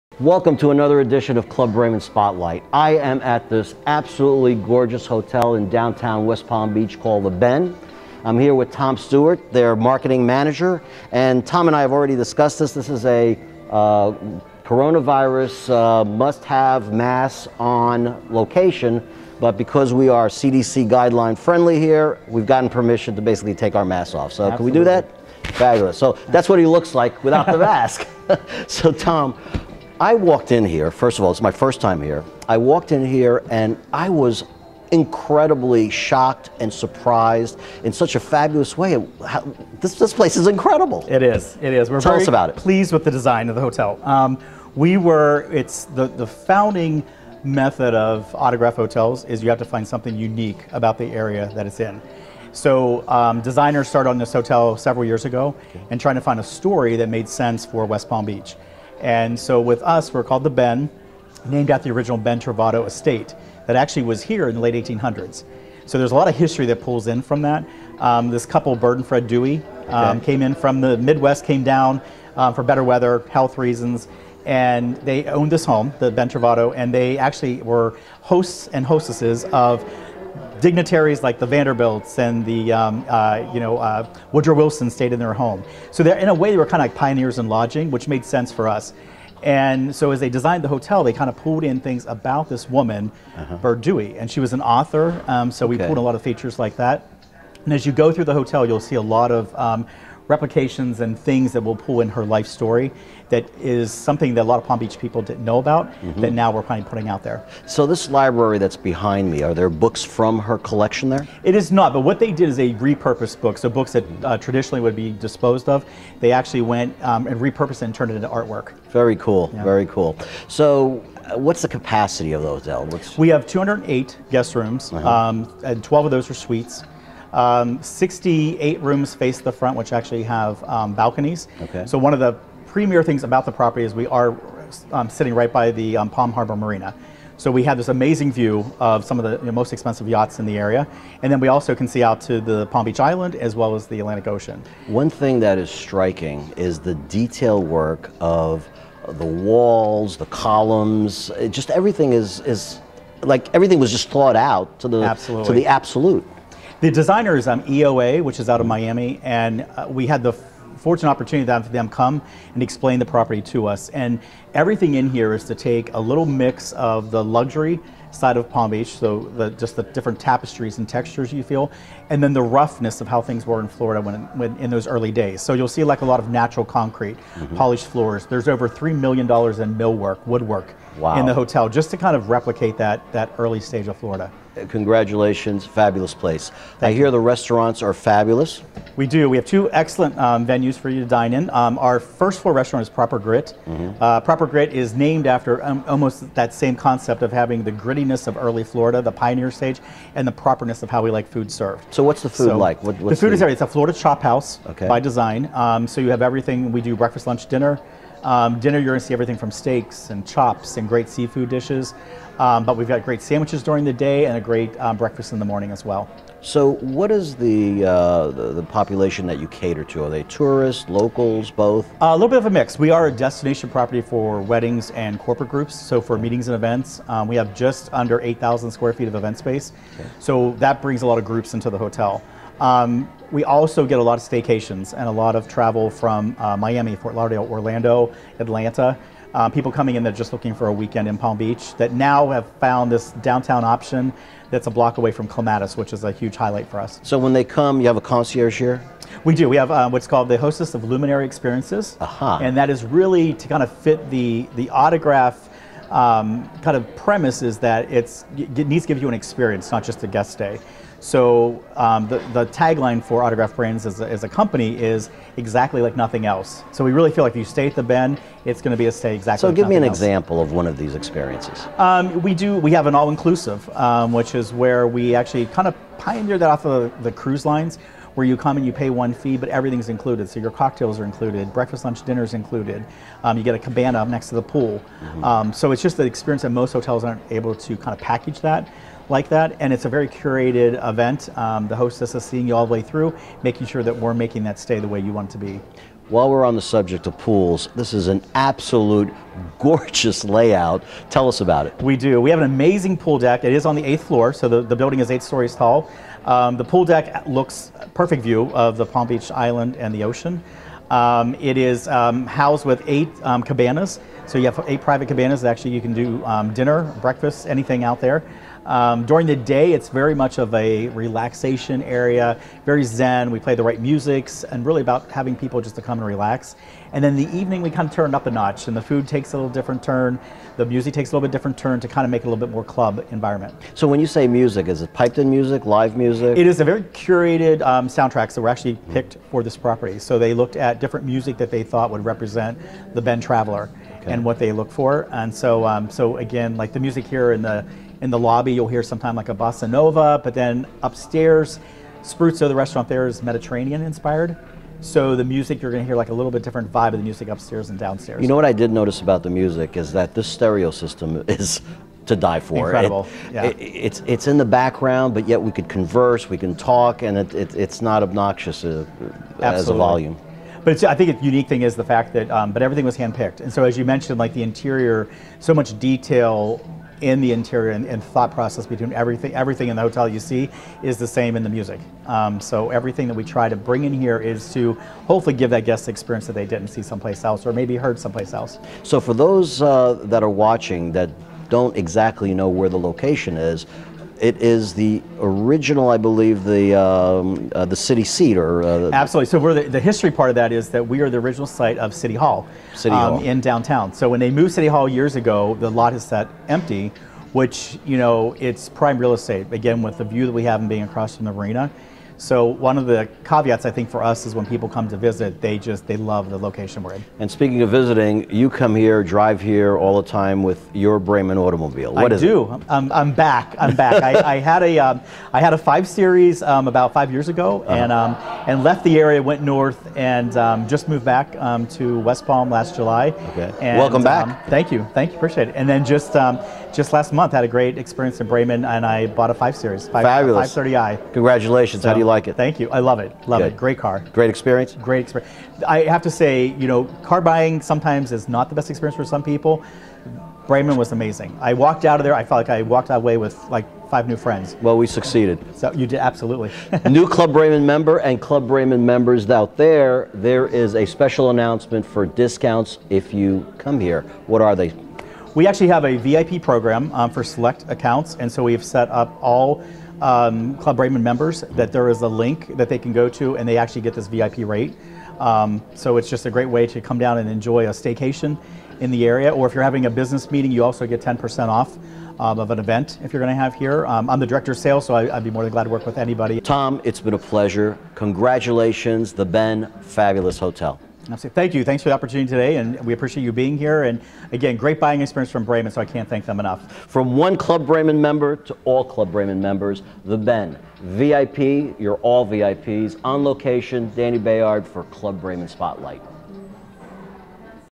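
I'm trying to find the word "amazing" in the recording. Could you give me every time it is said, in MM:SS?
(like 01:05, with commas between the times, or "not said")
02:17, 05:02, 07:30.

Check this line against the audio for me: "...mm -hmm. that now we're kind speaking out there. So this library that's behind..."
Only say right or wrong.
wrong.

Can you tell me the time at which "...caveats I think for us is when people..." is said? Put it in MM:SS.
06:53.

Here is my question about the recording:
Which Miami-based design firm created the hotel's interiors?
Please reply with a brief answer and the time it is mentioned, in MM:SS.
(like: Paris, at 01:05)
EOA, at 02:37.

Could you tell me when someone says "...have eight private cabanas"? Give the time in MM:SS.
05:14.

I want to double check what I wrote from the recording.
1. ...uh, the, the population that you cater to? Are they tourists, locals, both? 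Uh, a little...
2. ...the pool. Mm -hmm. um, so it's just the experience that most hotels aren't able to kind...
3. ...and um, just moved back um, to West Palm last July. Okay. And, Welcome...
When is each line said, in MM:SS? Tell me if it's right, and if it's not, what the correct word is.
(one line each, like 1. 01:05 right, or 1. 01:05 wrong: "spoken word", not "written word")
1. 03:37 right
2. 04:44 right
3. 07:09 right.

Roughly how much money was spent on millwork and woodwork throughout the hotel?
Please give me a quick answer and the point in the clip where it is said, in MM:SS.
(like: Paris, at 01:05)
3 million dollars, at 02:58.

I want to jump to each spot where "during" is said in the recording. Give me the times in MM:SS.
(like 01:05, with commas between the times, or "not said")
03:33, 05:19.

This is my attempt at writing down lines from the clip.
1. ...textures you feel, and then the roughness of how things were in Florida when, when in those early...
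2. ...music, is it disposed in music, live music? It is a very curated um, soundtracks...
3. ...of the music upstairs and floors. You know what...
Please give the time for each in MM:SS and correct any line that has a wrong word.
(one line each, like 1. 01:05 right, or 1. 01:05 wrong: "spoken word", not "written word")
1. 02:50 right
2. 05:34 wrong: "piped", not "disposed"
3. 05:56 wrong: "downstairs", not "floors".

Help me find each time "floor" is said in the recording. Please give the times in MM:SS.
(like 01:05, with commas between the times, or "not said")
02:57, 03:12, 05:04.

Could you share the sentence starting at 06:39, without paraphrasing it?
So we're the, the, history part of that is that we are the original site of City Hall, City um, Hall.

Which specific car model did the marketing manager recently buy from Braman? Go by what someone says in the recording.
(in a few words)
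530i.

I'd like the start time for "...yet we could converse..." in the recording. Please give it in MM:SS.
06:05.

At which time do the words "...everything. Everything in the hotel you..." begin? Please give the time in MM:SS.
06:18.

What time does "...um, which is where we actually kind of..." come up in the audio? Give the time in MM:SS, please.
04:33.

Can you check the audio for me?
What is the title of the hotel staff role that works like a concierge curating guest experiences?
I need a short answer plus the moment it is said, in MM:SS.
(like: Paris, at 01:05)
Hostess of Luminary Experiences, at 04:10.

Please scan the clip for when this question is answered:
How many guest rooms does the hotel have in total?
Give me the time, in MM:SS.
02:03.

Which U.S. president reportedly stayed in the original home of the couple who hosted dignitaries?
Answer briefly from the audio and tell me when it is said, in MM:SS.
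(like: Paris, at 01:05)
Woodrow Wilson, at 01:24.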